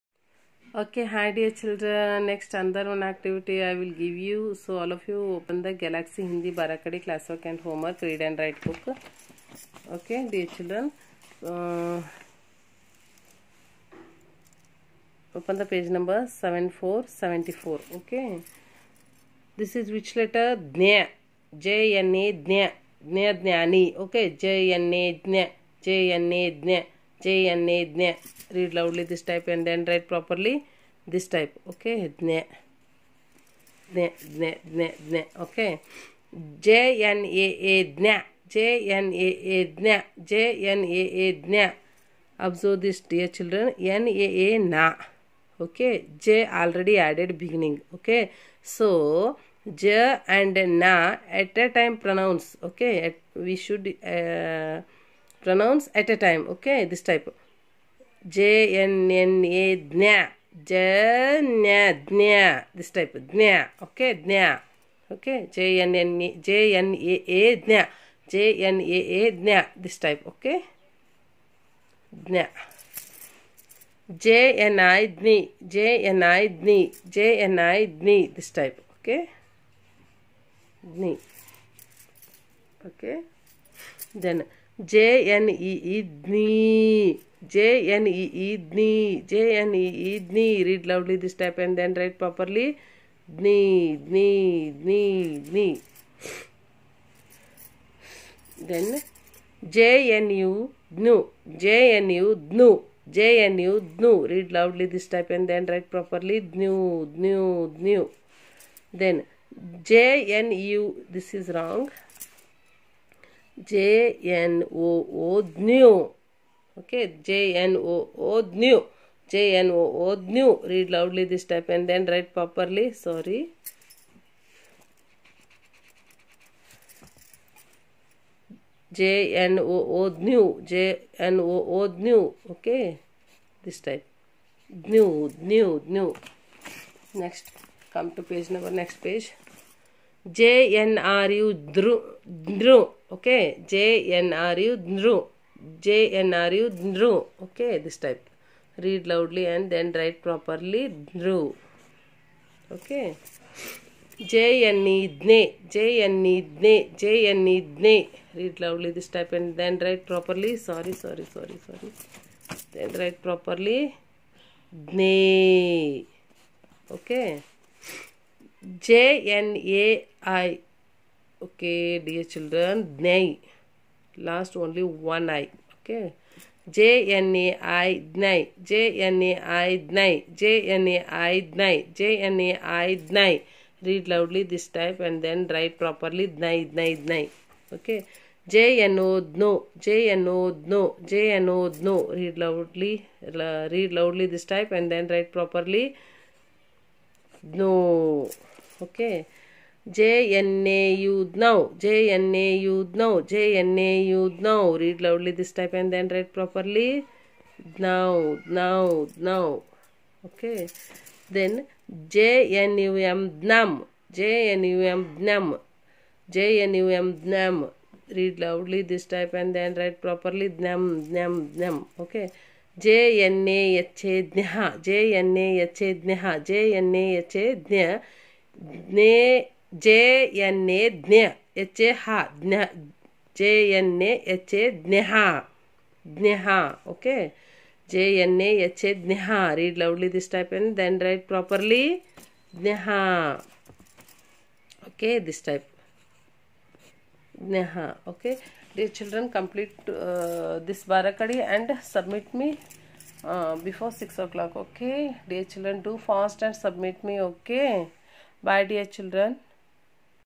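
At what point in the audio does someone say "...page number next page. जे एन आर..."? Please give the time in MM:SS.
02:18.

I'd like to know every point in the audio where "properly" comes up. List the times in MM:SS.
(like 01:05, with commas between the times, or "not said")
02:02, 03:05, 03:15, 03:26, 03:39.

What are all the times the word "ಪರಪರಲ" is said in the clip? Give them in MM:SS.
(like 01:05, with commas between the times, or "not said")
01:32, 01:45.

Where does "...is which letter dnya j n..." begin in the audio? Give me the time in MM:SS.
00:19.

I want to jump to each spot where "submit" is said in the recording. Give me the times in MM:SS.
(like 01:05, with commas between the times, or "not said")
04:11, 04:16.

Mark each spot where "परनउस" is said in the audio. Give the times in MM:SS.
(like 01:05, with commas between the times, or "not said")
00:52.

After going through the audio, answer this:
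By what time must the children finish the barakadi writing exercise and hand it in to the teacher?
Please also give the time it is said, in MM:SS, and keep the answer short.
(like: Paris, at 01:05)
6 o'clock, at 04:13.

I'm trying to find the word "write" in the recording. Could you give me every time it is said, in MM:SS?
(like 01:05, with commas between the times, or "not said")
00:08, 02:02, 03:05, 03:15, 03:26, 03:39.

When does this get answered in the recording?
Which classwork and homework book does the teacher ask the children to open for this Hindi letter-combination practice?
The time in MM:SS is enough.
00:05.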